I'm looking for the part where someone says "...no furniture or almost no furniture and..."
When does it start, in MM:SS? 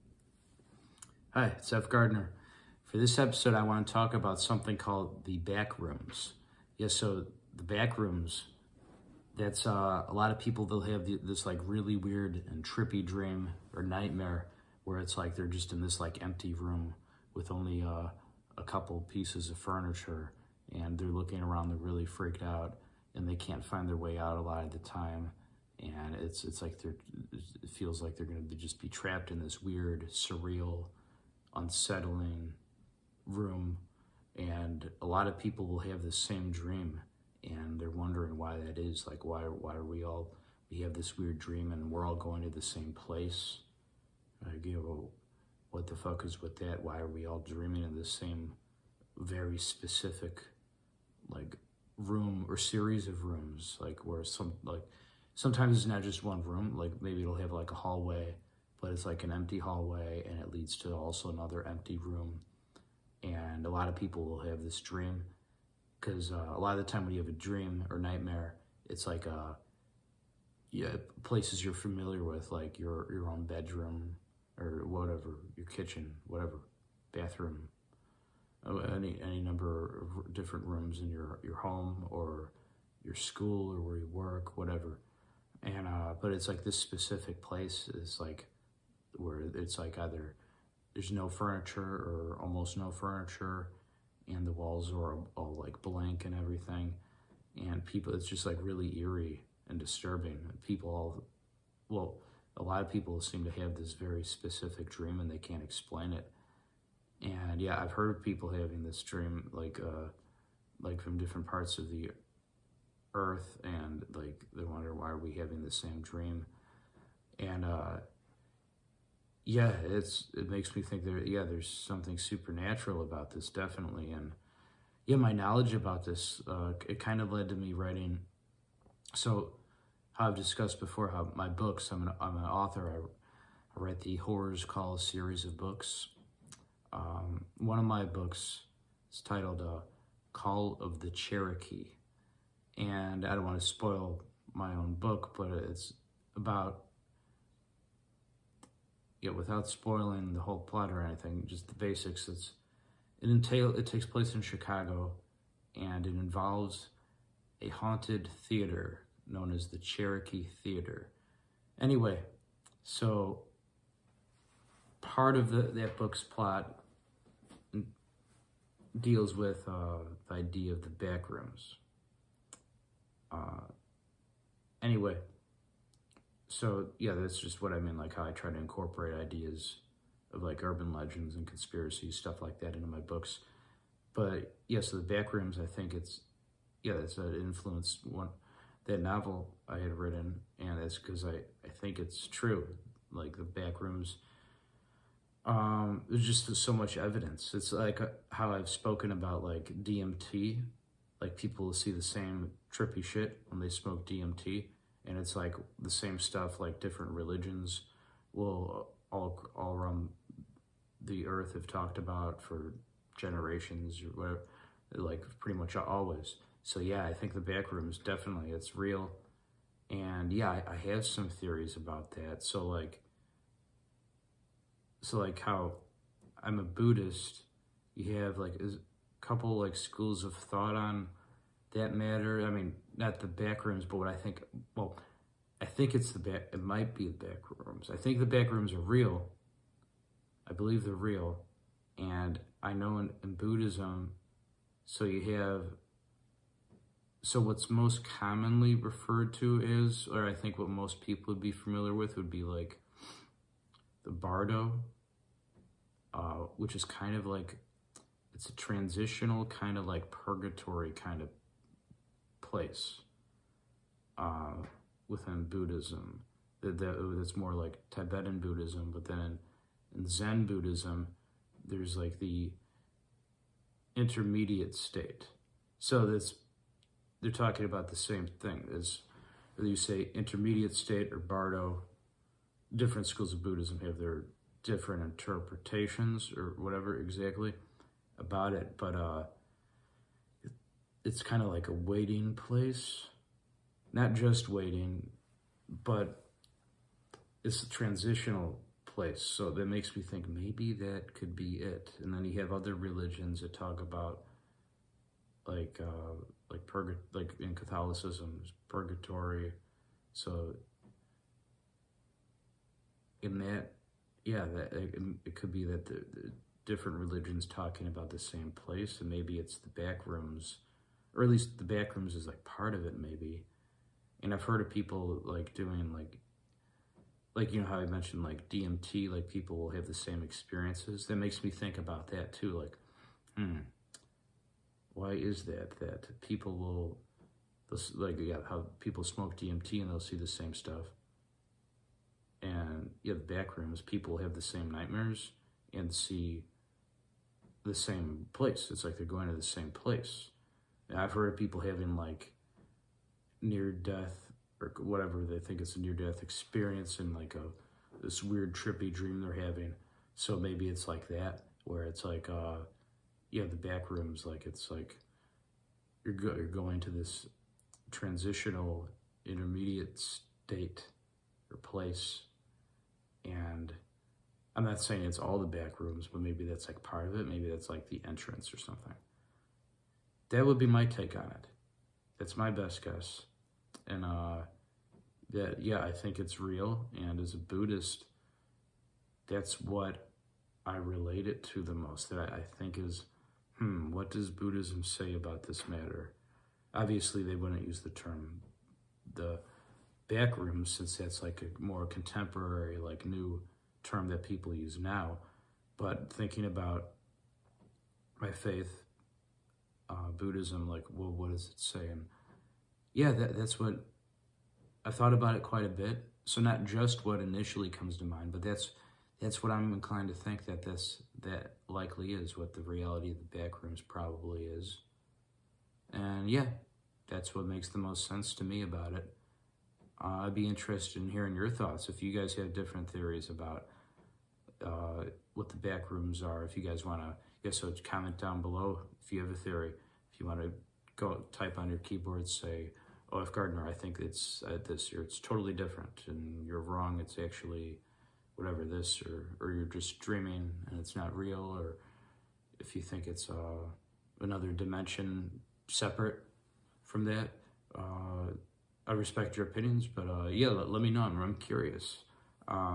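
01:31.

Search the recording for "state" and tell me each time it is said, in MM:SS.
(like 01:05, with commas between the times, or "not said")
04:34, 04:40, 06:09.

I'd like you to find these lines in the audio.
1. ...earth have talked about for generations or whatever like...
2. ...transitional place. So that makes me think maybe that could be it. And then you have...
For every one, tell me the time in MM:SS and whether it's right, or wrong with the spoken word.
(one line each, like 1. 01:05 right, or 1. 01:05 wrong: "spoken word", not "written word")
1. 03:31 right
2. 04:57 right.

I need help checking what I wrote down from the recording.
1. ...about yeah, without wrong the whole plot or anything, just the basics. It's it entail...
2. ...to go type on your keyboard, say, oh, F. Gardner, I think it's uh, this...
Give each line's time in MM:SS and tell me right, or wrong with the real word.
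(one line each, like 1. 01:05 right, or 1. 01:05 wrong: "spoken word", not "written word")
1. 02:26 wrong: "spoiling", not "wrong"
2. 07:20 right.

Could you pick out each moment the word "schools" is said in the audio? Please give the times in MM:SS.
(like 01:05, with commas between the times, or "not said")
01:23, 03:49, 04:43.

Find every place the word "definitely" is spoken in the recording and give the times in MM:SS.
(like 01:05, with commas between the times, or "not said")
02:03, 03:37.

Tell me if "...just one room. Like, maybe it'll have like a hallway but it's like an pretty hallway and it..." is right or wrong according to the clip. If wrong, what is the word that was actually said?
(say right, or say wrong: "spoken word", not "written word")
wrong: "empty", not "pretty".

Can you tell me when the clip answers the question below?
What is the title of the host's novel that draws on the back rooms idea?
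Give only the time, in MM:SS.
02:20.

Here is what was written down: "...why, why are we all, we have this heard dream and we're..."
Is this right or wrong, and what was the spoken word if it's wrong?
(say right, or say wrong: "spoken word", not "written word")
wrong: "weird", not "heard".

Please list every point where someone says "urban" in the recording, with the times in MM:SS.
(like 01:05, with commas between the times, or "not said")
03:00.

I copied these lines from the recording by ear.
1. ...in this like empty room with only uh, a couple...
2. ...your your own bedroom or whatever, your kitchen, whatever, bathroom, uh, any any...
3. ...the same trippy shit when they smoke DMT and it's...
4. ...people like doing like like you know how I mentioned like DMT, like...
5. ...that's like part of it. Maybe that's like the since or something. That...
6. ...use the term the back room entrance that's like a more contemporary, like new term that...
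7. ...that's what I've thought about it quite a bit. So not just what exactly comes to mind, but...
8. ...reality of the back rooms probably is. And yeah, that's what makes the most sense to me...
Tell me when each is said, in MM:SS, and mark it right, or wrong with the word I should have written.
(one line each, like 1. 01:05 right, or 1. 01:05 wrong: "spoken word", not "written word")
1. 00:15 right
2. 01:12 right
3. 03:21 right
4. 05:24 right
5. 06:16 wrong: "entrance", not "since"
6. 06:37 wrong: "since", not "entrance"
7. 06:53 wrong: "initially", not "exactly"
8. 07:02 right.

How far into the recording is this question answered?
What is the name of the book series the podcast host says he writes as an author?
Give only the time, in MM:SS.
02:14.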